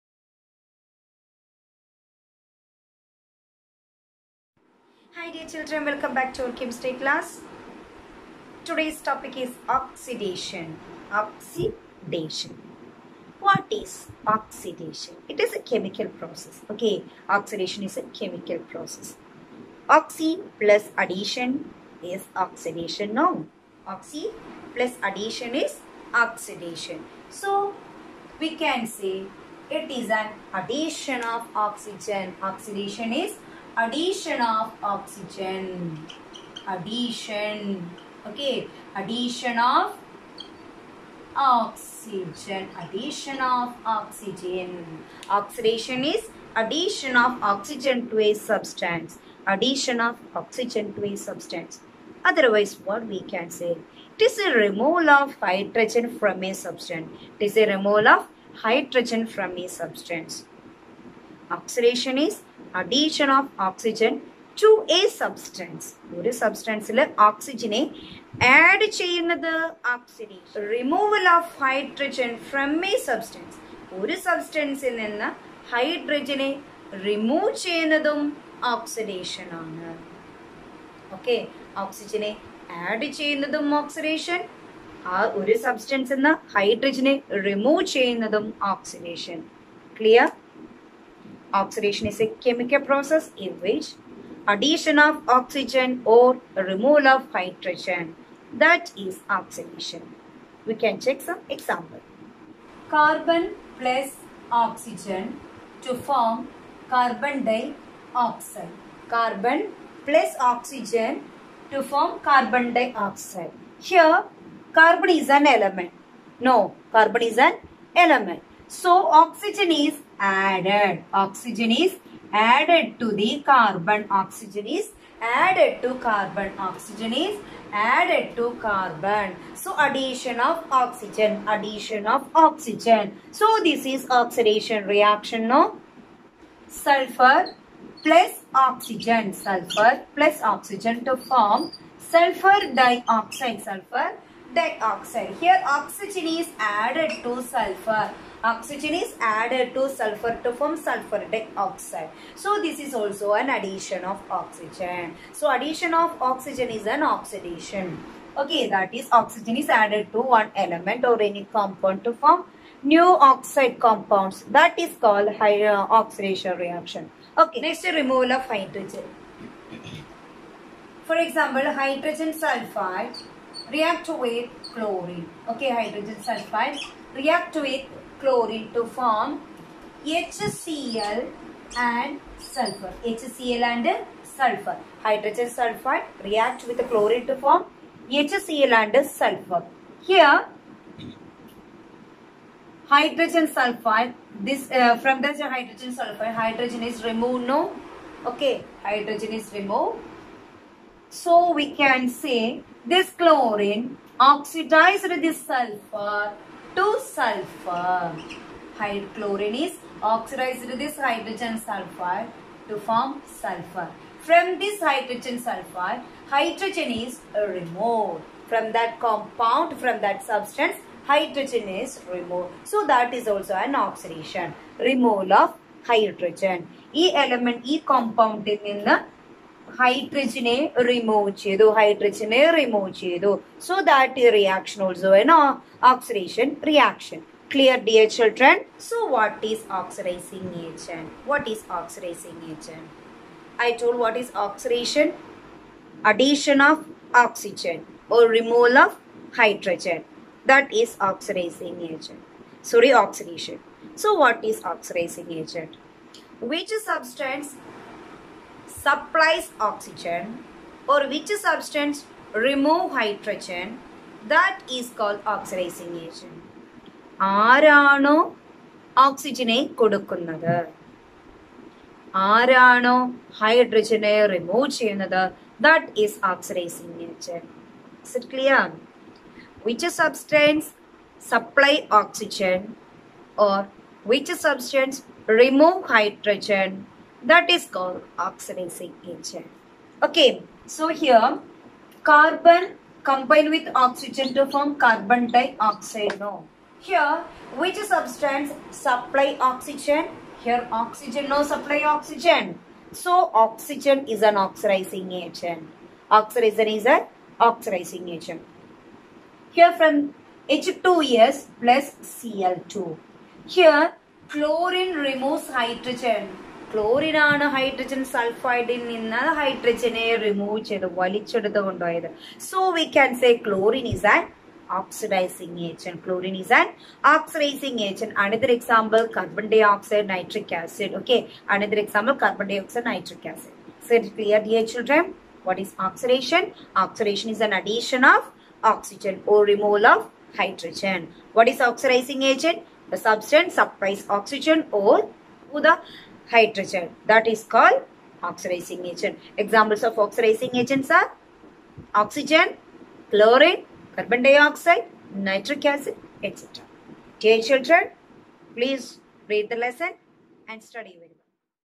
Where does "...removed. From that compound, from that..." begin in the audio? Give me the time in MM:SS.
03:37.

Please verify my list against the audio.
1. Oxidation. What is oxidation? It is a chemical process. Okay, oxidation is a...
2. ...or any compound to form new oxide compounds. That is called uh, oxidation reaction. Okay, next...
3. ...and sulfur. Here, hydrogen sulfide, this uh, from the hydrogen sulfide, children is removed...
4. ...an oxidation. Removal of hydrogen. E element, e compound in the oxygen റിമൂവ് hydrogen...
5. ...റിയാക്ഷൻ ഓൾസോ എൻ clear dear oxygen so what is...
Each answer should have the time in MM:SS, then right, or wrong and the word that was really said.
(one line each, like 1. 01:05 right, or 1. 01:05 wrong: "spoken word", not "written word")
1. 00:11 right
2. 02:41 right
3. 03:08 wrong: "hydrogen", not "children"
4. 03:43 wrong: "hydrogen", not "oxygen"
5. 03:54 wrong: "children", not "oxygen".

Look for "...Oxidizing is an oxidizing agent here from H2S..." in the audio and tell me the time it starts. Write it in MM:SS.
05:06.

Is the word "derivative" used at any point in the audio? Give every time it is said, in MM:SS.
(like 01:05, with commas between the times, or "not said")
not said.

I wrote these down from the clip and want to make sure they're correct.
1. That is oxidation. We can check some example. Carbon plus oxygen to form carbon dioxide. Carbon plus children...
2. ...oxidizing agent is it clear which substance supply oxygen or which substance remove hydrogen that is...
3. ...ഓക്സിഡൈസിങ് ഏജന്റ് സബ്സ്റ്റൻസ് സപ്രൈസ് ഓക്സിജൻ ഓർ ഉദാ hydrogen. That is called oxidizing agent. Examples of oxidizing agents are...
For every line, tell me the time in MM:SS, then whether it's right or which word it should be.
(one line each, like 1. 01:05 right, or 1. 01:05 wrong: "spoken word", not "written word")
1. 01:38 wrong: "oxygen", not "children"
2. 04:36 right
3. 05:41 right.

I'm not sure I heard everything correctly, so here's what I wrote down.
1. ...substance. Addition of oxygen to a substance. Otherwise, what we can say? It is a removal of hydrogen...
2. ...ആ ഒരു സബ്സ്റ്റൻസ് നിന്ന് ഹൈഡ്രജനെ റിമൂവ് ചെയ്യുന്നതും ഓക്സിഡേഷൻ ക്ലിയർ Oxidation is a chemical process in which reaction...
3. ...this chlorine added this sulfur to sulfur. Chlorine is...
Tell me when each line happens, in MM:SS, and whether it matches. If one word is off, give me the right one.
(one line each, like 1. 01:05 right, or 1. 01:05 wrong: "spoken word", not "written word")
1. 00:48 right
2. 01:25 wrong: "addition", not "reaction"
3. 03:22 wrong: "oxidized", not "added".